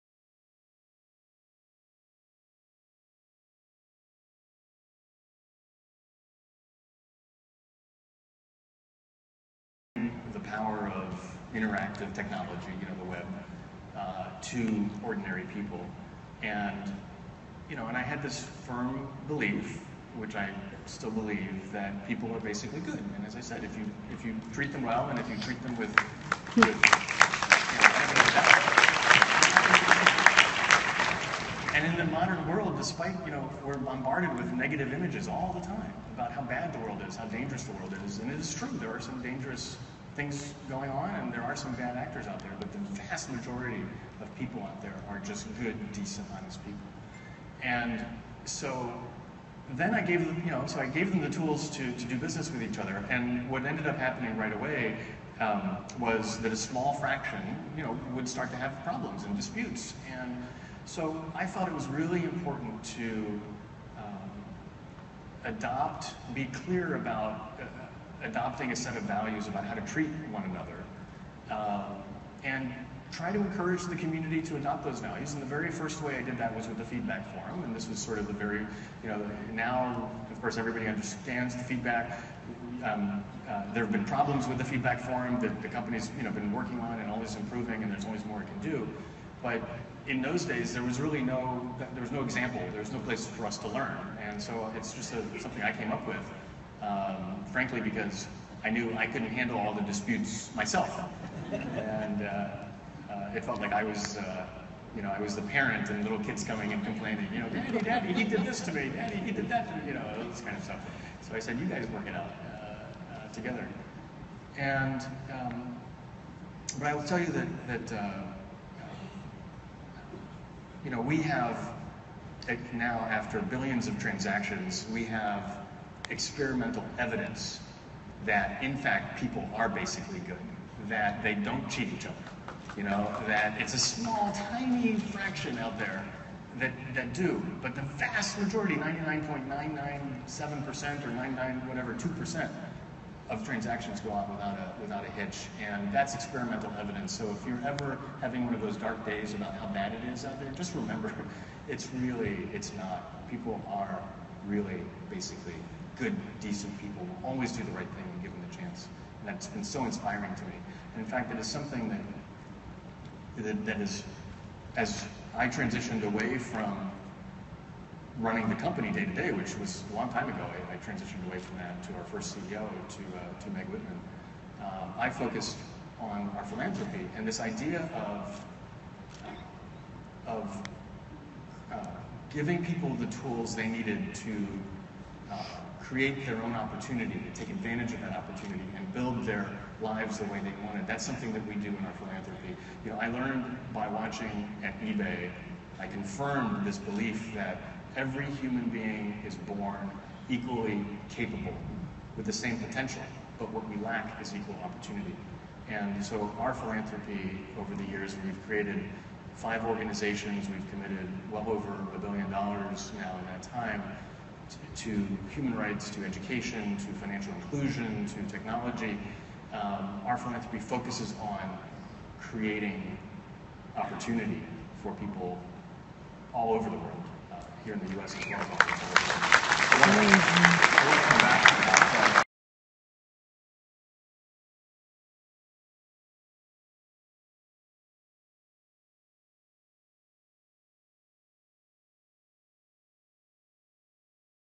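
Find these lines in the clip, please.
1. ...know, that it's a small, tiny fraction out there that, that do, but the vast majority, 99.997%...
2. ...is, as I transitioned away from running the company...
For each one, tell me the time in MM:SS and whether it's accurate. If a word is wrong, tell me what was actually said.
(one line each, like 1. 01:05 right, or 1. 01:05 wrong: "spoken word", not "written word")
1. 02:12 right
2. 02:43 right.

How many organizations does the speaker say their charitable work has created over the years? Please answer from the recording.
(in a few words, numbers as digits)
5.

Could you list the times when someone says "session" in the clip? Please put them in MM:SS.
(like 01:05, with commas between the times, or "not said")
not said.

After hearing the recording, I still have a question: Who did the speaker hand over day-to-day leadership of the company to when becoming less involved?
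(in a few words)
Meg Whitman.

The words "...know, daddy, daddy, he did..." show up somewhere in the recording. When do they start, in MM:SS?
01:47.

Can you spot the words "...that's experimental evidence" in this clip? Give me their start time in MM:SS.
02:25.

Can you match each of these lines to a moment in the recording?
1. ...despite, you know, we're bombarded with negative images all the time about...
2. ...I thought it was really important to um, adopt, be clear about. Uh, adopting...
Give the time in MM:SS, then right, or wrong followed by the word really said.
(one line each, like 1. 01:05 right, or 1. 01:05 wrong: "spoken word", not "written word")
1. 00:32 right
2. 01:01 right.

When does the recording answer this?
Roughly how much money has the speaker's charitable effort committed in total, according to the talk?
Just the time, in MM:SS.
03:31.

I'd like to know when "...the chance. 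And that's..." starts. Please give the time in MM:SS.
02:38.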